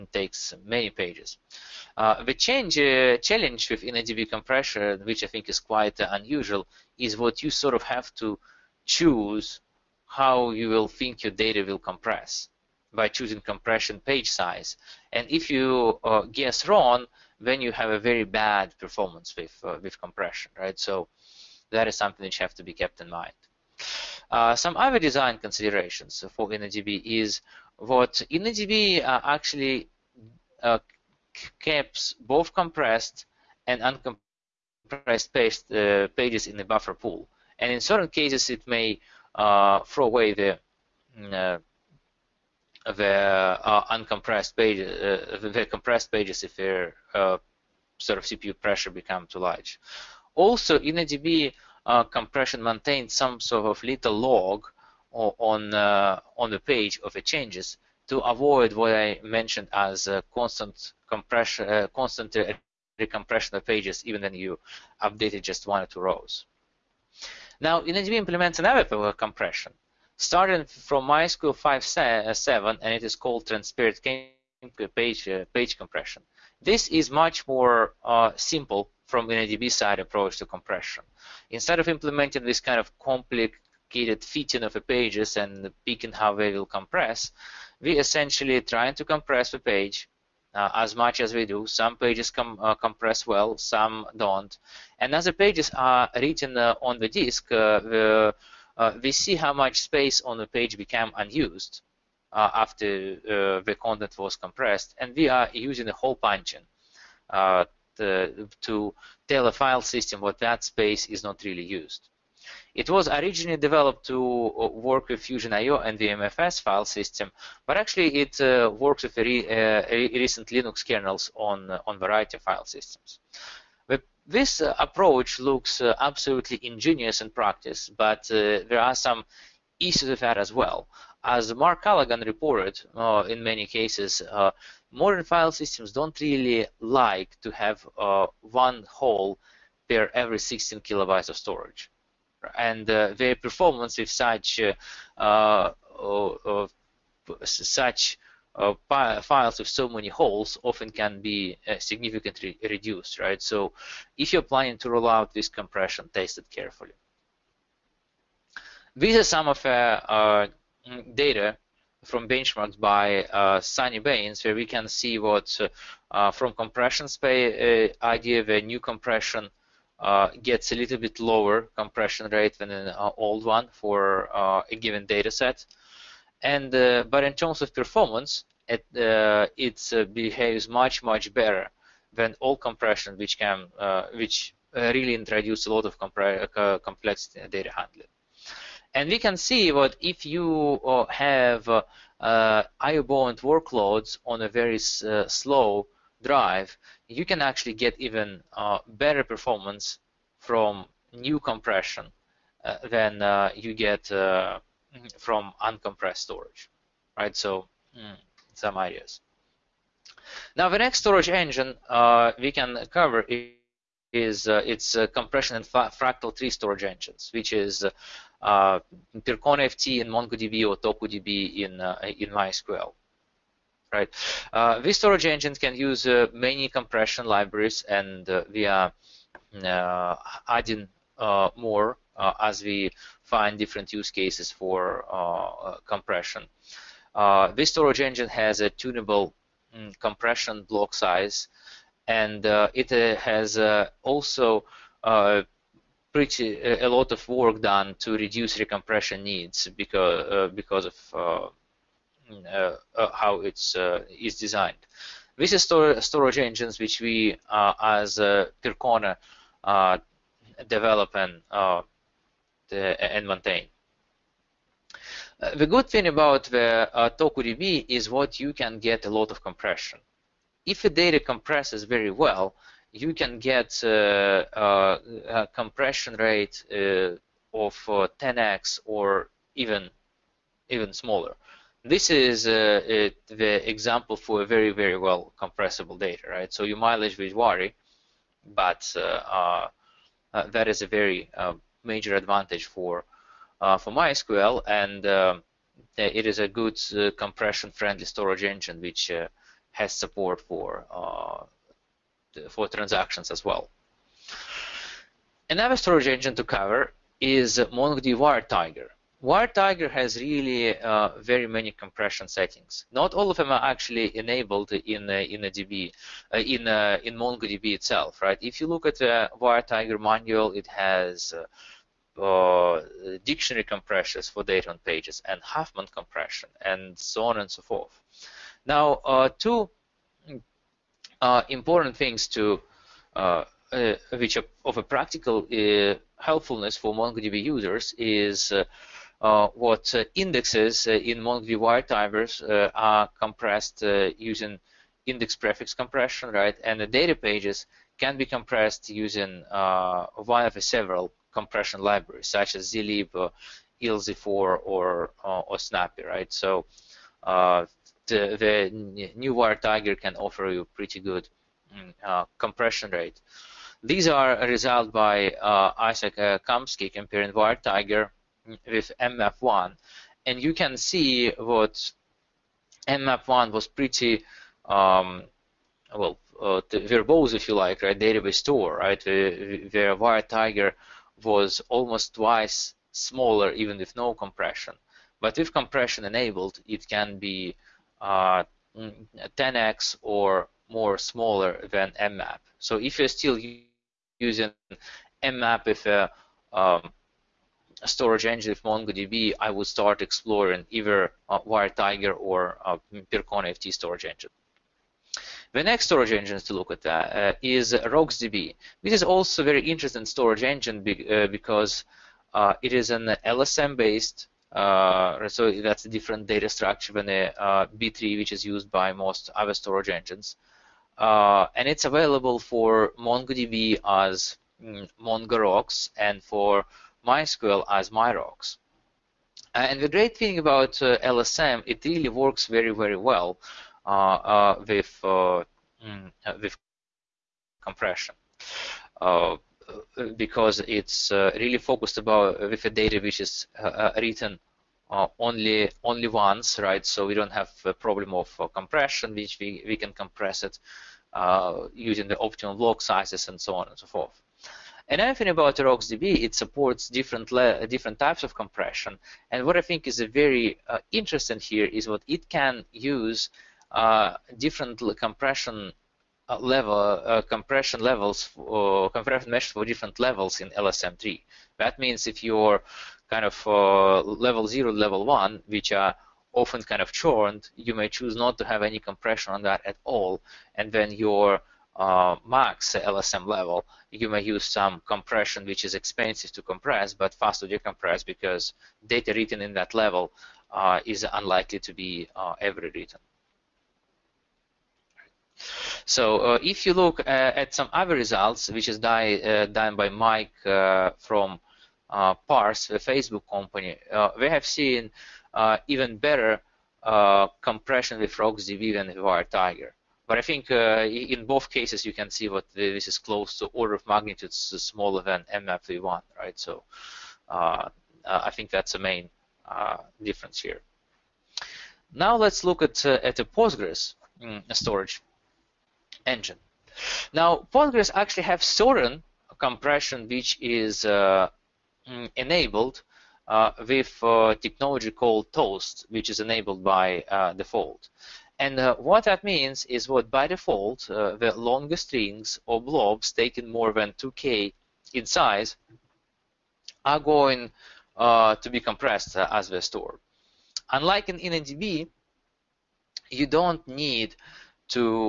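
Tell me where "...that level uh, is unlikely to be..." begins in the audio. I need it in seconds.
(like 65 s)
489 s.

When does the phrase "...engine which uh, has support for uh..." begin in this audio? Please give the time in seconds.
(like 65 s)
298 s.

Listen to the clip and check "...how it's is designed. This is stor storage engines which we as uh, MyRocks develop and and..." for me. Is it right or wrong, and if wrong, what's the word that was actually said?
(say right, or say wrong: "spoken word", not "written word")
wrong: "Percona", not "MyRocks".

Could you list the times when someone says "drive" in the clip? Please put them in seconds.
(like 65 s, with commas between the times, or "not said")
196 s.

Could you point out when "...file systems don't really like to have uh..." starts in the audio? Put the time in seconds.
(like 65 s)
135 s.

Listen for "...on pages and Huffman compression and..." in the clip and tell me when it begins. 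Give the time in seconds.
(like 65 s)
324 s.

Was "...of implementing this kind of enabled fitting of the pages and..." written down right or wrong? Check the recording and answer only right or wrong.
wrong.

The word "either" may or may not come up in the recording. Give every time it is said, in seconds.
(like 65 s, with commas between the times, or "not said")
400 s.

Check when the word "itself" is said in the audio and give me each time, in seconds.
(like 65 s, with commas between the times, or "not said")
317 s.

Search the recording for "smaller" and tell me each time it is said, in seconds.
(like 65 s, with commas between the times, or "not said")
280 s, 382 s, 390 s, 514 s.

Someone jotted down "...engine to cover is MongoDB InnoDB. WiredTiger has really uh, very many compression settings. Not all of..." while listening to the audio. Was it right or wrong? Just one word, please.
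wrong.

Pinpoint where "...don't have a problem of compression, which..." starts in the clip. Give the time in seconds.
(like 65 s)
447 s.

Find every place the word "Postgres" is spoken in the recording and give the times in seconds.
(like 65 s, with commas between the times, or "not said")
523 s, 527 s.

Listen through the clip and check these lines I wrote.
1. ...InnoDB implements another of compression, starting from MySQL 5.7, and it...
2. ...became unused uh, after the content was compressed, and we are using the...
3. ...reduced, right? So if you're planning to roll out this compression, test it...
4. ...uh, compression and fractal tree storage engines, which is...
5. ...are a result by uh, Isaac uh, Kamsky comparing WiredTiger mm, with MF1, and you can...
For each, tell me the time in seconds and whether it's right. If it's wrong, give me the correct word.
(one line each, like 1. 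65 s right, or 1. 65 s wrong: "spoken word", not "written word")
1. 67 s right
2. 100 s right
3. 152 s right
4. 214 s right
5. 364 s right.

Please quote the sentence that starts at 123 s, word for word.
But this uh, approach looks absolutely ingenious in practice, but there are some issues with that as well.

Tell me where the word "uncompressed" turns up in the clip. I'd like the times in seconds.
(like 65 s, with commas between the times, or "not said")
33 s, 43 s, 205 s.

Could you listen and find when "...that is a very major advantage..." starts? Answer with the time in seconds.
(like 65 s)
290 s.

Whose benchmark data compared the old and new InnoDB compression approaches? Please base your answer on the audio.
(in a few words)
Sunny Bains.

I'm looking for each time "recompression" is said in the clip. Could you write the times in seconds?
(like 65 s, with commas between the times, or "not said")
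62 s, 248 s.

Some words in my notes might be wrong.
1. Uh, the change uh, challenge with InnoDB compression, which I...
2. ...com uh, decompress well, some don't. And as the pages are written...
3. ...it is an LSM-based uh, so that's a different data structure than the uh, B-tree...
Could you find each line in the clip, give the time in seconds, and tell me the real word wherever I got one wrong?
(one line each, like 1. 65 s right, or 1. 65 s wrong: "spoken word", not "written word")
1. 1 s right
2. 92 s wrong: "compress", not "decompress"
3. 412 s right.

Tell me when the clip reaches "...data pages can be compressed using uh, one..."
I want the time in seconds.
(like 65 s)
346 s.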